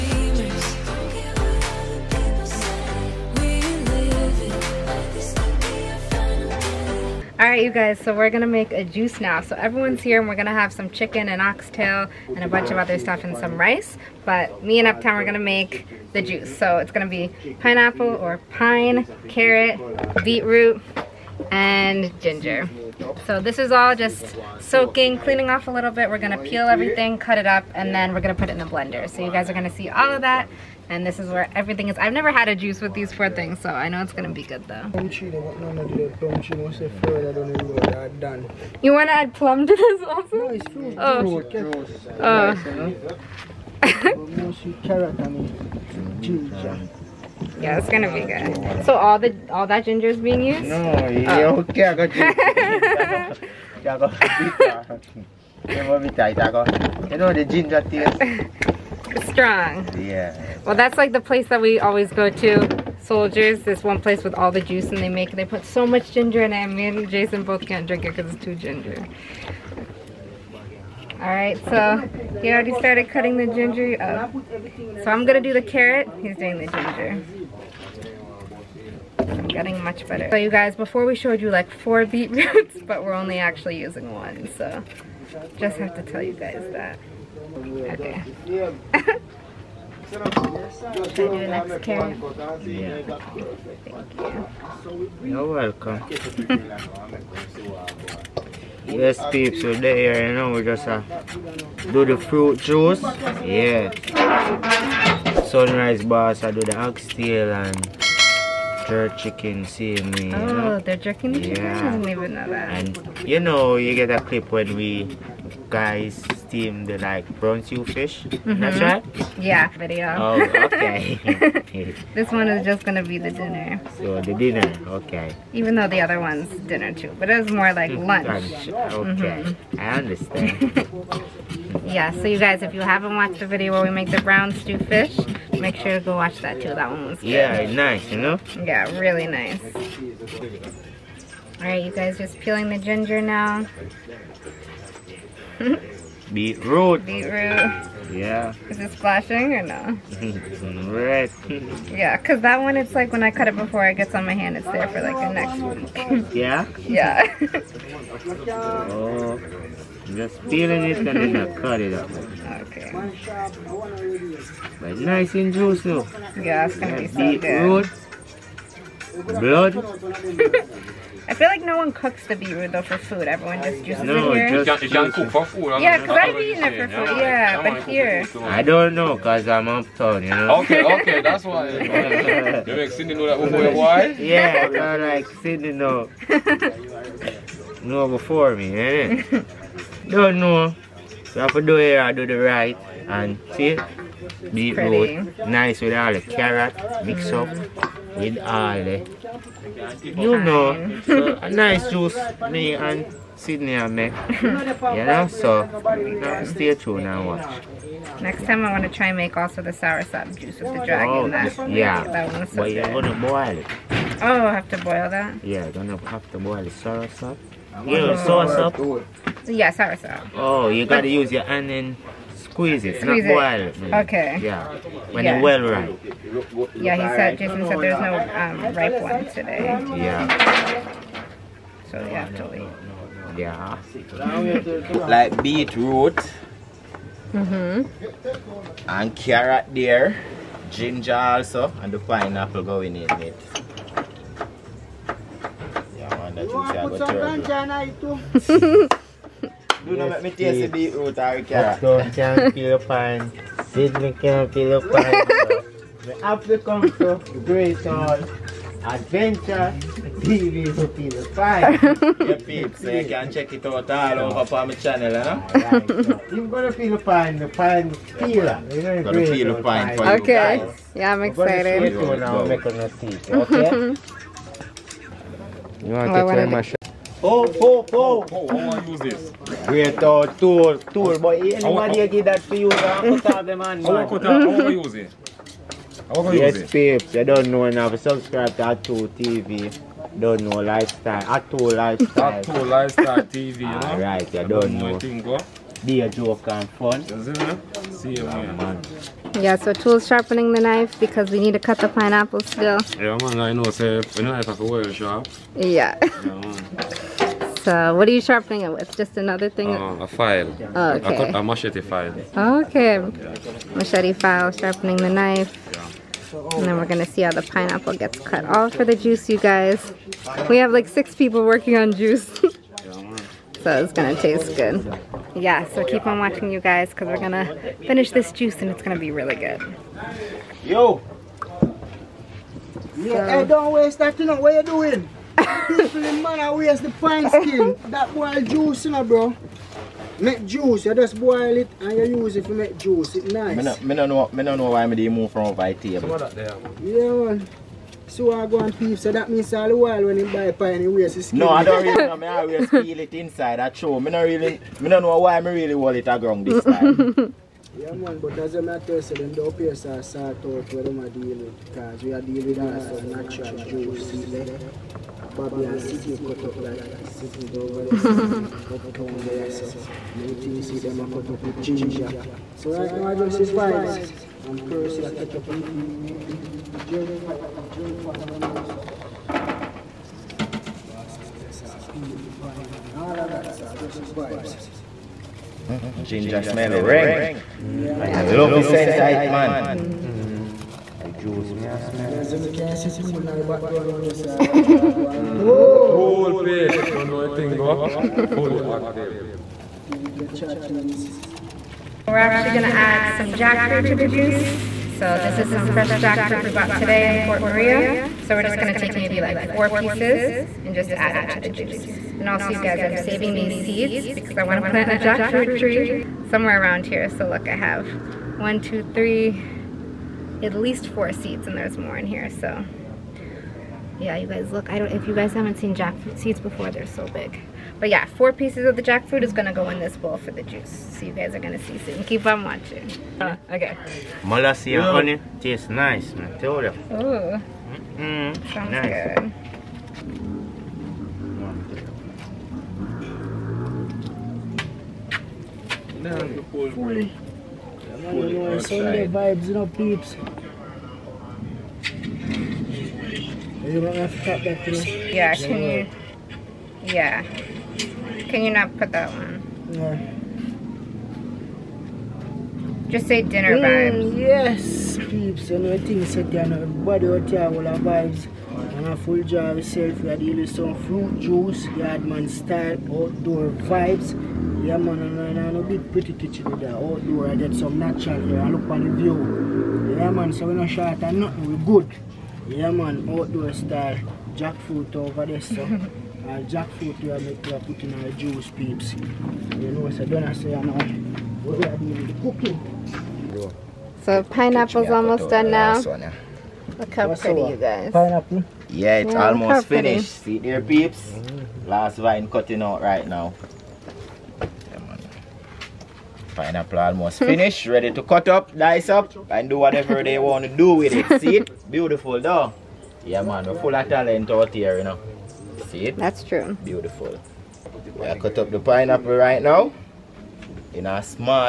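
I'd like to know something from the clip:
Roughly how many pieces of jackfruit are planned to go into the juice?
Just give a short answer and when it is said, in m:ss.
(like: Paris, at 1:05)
4, at 6:48.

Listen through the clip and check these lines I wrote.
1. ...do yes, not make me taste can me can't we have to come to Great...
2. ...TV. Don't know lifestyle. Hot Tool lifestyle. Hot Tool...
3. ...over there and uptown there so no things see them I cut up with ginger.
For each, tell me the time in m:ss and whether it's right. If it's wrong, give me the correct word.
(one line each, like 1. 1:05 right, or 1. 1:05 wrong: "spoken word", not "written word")
1. 4:09 right
2. 4:49 right
3. 6:07 right.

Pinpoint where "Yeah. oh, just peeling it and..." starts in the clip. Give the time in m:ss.
2:36.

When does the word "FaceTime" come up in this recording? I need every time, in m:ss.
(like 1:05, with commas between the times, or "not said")
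not said.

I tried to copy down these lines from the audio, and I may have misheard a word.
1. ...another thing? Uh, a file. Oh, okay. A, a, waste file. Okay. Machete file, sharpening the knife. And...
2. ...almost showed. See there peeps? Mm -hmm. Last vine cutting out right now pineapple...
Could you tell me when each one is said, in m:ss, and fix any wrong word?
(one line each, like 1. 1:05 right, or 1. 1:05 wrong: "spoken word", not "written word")
1. 5:09 wrong: "machete", not "waste"
2. 8:19 wrong: "finished", not "showed".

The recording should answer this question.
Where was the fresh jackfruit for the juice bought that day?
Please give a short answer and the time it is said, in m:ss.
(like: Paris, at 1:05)
Port Maria, at 6:47.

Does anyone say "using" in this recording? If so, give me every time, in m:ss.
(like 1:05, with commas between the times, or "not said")
1:23.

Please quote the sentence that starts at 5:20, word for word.
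We have like six people working on juice.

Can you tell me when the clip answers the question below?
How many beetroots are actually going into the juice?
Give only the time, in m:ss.
1:23.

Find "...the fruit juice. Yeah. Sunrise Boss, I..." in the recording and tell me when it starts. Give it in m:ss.
1:42.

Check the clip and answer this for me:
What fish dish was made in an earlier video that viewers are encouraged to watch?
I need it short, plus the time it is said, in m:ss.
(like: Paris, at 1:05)
Brown stew fish, at 2:14.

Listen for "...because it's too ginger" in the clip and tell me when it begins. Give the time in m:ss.
1:08.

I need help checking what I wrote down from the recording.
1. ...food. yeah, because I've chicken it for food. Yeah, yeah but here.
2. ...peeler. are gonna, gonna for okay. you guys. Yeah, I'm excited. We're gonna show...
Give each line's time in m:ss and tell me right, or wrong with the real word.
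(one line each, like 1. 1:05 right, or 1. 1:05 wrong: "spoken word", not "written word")
1. 2:55 wrong: "eaten", not "chicken"
2. 4:28 right.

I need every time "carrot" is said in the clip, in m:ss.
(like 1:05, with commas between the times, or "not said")
0:19, 1:15, 3:16, 3:59.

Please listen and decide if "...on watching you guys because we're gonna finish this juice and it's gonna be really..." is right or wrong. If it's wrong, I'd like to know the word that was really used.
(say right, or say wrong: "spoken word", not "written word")
right.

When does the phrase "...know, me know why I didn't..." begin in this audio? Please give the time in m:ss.
5:44.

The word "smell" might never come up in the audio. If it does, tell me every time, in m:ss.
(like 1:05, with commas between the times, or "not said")
6:26.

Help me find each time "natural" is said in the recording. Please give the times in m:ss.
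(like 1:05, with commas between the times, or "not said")
6:03, 7:57.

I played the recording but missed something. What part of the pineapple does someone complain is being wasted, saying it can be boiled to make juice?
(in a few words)
The skin.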